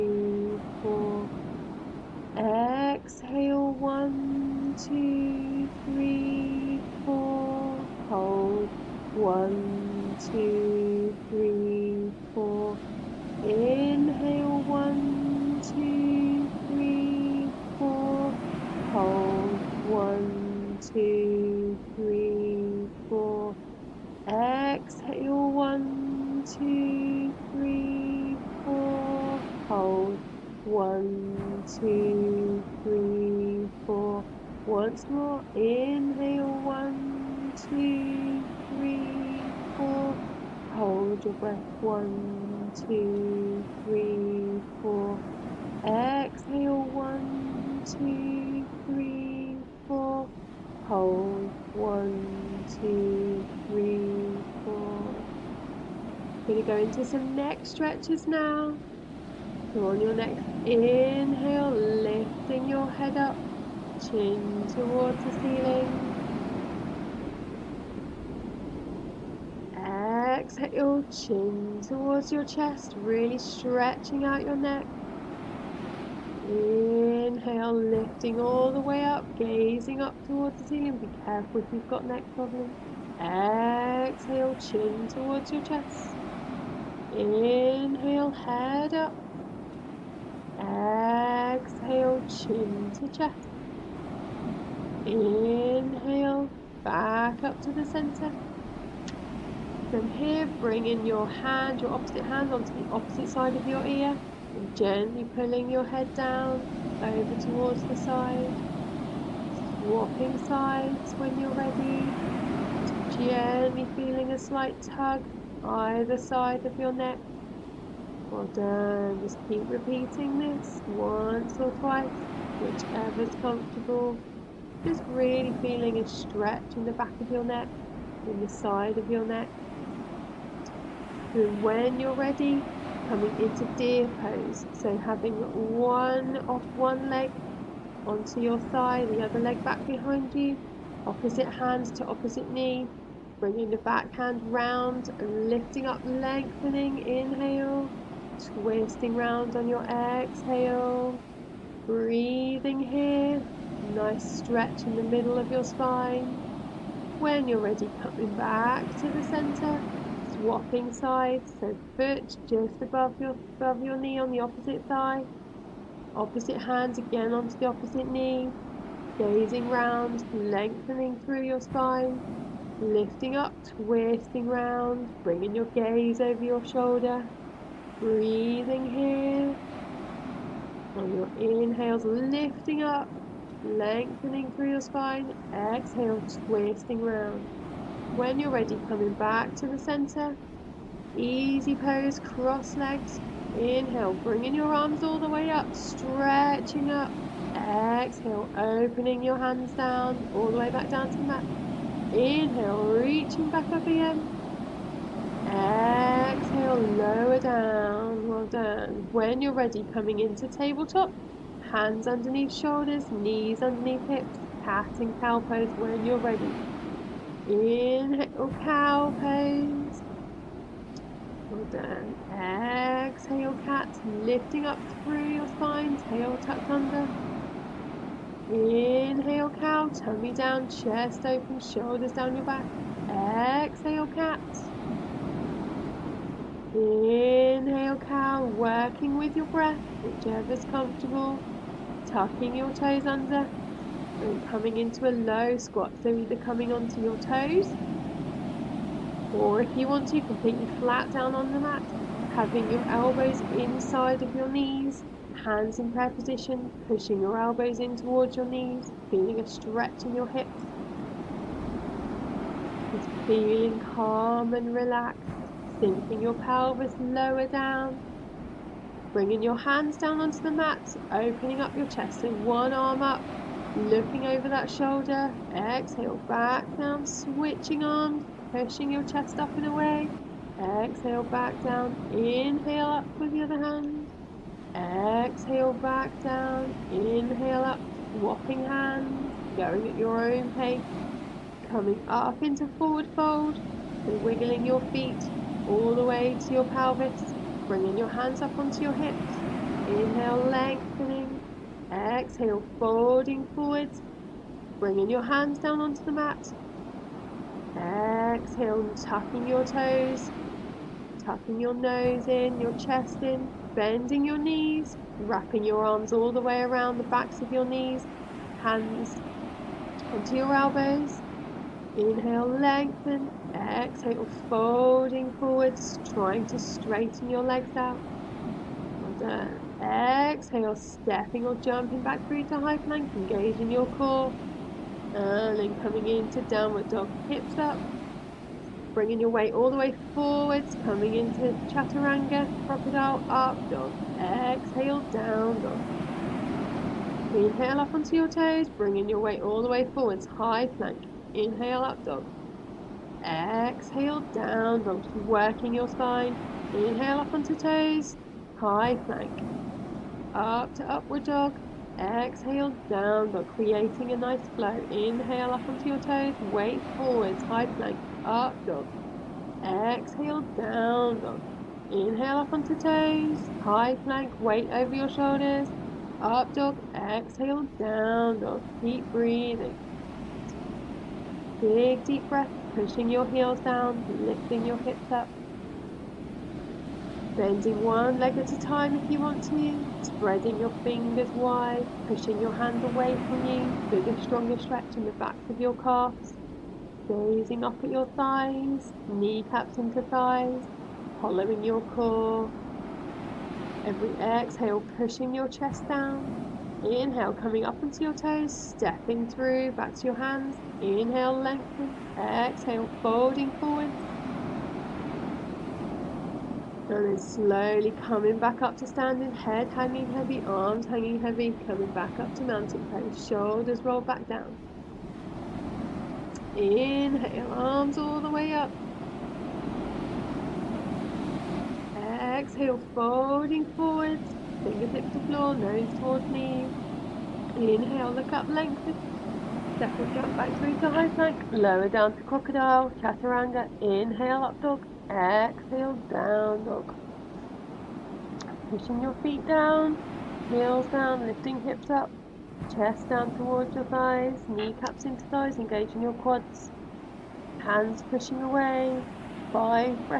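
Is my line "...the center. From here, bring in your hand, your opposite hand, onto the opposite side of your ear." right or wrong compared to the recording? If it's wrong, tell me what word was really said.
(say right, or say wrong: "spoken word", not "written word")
right.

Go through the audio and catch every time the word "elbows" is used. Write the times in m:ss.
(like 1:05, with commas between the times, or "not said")
4:12, 4:17, 5:20.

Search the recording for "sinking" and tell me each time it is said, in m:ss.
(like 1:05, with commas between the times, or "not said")
4:25.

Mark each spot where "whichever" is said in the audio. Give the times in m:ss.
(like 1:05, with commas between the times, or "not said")
2:02, 4:00.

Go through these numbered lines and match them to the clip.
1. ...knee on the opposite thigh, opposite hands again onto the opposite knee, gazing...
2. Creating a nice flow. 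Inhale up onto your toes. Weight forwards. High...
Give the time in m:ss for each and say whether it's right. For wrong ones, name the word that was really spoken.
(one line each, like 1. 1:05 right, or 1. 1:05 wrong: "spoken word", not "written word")
1. 2:43 right
2. 6:03 right.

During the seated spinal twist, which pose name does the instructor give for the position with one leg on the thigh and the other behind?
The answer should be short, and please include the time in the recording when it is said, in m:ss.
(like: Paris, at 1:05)
deer pose, at 2:13.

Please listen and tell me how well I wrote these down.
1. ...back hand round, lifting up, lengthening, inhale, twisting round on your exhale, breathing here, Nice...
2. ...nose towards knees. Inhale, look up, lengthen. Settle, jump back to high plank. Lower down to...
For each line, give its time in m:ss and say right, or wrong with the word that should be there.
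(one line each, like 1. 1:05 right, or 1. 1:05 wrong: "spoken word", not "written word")
1. 2:23 right
2. 7:15 right.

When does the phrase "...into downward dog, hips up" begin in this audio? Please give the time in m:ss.
5:36.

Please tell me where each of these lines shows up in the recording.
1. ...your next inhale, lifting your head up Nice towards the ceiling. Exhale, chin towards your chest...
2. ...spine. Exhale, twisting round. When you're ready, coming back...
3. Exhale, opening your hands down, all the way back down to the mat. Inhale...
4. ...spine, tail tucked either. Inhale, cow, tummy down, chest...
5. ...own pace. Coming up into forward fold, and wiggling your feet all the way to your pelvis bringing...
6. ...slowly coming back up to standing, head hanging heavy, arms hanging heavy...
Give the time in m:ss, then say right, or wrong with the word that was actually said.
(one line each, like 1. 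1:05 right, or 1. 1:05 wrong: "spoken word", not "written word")
1. 1:00 wrong: "Chin", not "Nice"
2. 3:04 right
3. 3:17 right
4. 3:45 wrong: "under", not "either"
5. 4:50 right
6. 6:57 right.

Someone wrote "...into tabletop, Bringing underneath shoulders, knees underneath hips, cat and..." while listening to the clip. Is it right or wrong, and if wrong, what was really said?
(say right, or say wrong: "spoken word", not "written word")
wrong: "Hands", not "Bringing".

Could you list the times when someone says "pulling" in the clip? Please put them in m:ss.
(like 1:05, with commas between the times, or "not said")
1:45.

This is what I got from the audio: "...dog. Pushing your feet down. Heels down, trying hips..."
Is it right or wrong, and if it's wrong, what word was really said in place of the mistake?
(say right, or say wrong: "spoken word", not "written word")
wrong: "lifting", not "trying".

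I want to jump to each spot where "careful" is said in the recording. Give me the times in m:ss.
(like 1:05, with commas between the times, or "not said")
1:21.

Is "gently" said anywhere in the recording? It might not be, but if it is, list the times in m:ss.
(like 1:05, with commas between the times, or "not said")
1:44, 1:53.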